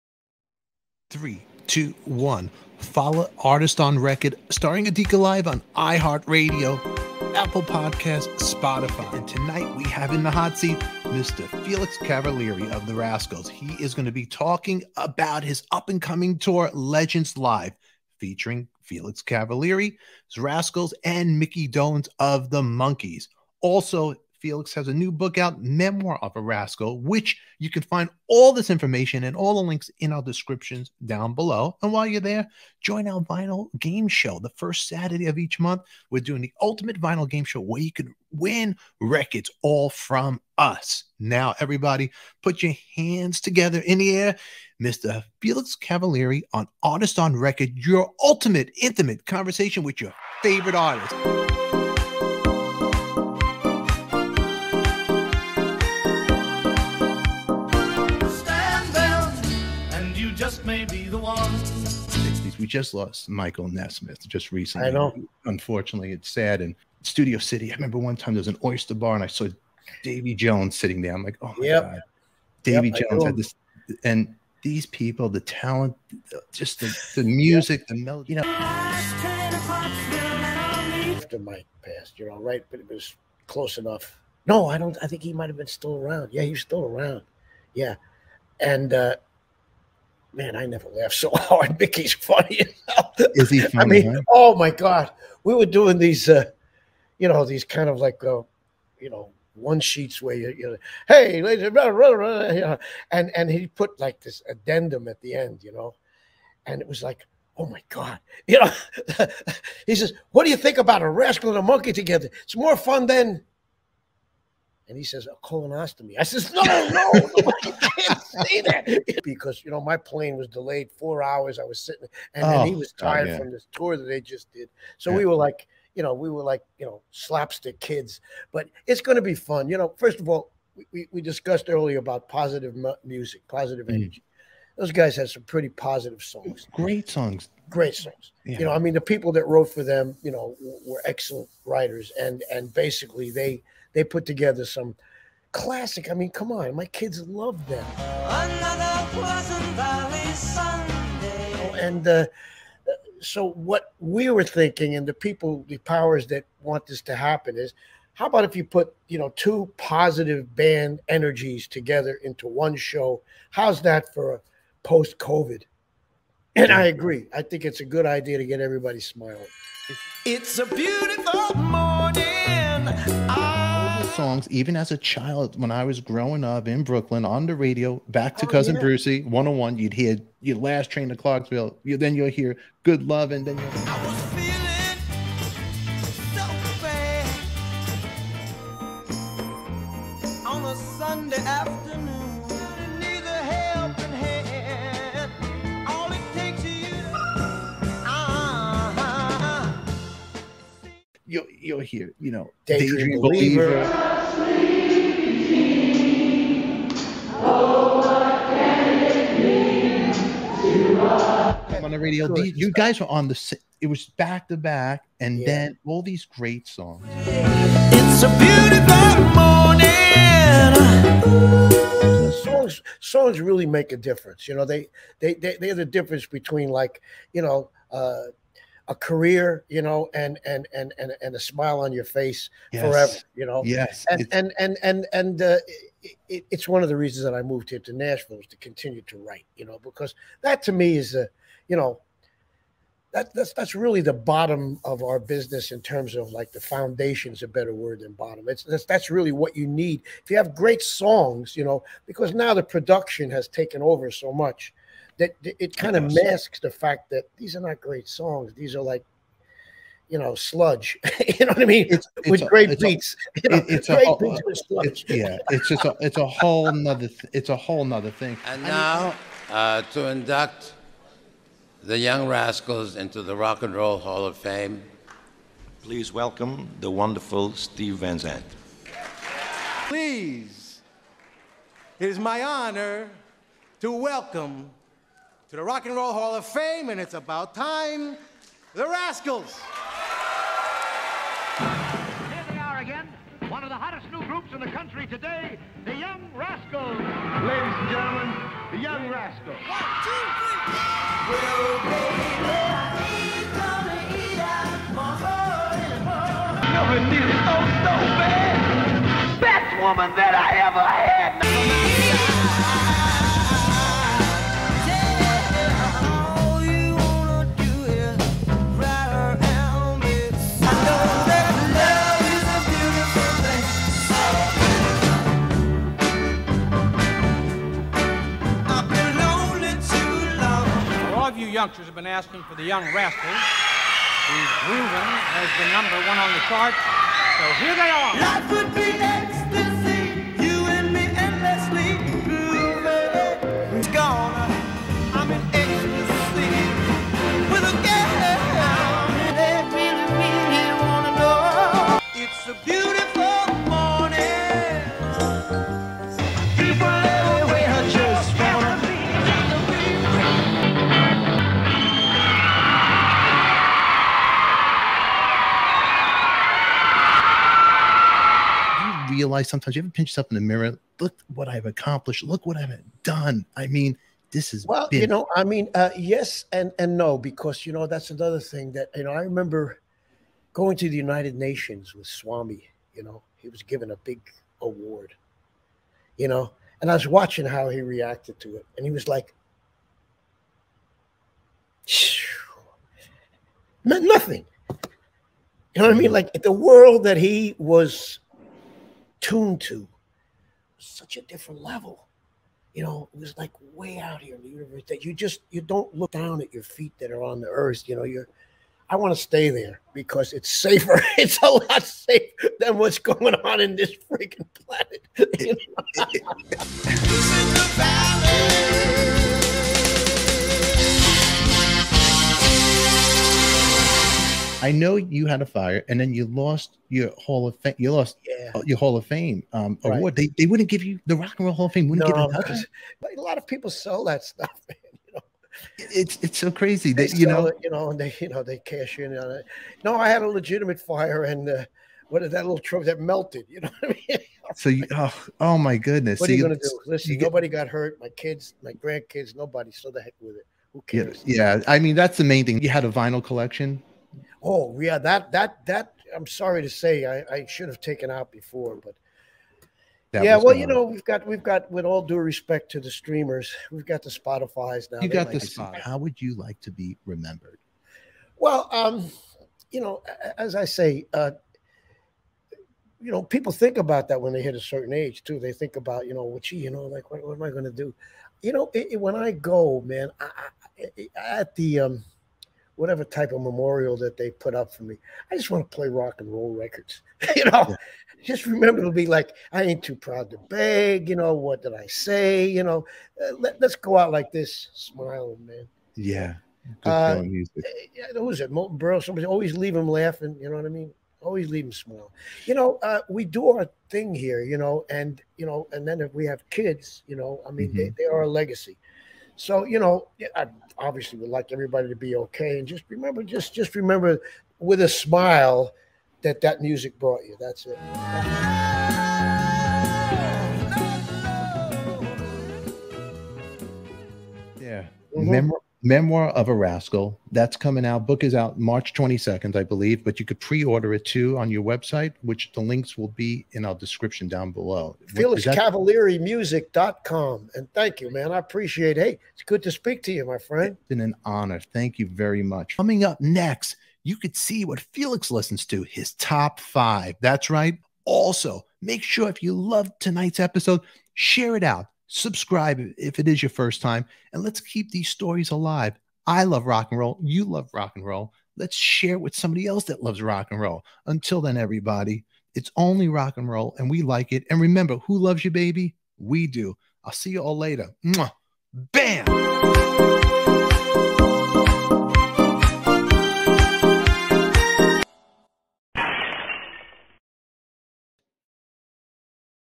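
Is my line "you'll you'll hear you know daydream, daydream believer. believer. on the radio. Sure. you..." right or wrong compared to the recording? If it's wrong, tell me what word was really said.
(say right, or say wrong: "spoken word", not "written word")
right.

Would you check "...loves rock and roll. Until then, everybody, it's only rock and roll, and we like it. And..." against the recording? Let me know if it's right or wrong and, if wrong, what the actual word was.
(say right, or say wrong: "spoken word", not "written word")
right.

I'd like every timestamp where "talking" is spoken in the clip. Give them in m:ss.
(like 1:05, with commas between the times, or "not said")
0:14.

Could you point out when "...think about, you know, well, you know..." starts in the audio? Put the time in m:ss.
7:55.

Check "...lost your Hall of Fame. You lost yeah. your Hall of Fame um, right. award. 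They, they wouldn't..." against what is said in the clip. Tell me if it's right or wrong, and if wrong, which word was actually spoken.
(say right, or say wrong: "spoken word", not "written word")
right.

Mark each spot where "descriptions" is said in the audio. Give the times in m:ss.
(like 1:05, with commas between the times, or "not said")
0:30, 8:53.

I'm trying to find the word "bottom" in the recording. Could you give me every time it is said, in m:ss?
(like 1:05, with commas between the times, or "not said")
4:04, 4:08.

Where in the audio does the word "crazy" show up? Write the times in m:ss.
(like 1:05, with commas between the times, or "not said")
7:16.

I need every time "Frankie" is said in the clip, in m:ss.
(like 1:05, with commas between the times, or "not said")
not said.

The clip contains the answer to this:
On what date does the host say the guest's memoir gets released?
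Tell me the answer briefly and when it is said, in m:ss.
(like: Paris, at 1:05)
March 22, at 8:48.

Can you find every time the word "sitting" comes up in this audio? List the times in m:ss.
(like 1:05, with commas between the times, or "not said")
1:10, 2:01.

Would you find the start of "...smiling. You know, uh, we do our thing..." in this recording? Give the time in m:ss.
8:21.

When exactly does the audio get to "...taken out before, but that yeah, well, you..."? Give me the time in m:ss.
7:37.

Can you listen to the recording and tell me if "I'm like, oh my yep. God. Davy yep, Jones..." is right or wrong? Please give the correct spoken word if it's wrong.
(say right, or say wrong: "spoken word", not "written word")
right.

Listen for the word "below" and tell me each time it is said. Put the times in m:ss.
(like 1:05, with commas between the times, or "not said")
0:31, 8:54.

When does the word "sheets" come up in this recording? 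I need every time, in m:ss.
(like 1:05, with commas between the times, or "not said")
1:39.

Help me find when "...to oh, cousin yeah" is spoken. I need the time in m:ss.
2:58.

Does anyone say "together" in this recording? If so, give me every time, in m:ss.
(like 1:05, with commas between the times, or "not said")
0:43, 1:51, 2:24, 2:41.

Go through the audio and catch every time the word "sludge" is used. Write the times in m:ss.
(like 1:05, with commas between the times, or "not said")
4:20, 4:24.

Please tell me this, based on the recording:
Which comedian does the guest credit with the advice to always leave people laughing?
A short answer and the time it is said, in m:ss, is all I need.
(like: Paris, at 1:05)
Milton Berle, at 8:18.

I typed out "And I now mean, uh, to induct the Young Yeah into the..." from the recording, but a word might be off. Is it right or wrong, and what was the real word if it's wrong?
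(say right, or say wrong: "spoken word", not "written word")
wrong: "Rascals", not "Yeah".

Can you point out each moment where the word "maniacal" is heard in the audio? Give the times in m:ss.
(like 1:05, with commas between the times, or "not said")
not said.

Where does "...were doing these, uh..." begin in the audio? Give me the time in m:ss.
1:35.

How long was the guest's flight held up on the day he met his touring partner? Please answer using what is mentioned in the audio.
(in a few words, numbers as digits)
4 hours.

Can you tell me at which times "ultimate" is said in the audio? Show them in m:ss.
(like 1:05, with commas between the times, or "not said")
0:36, 0:48.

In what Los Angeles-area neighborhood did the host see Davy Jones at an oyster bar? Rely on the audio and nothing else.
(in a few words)
Studio City.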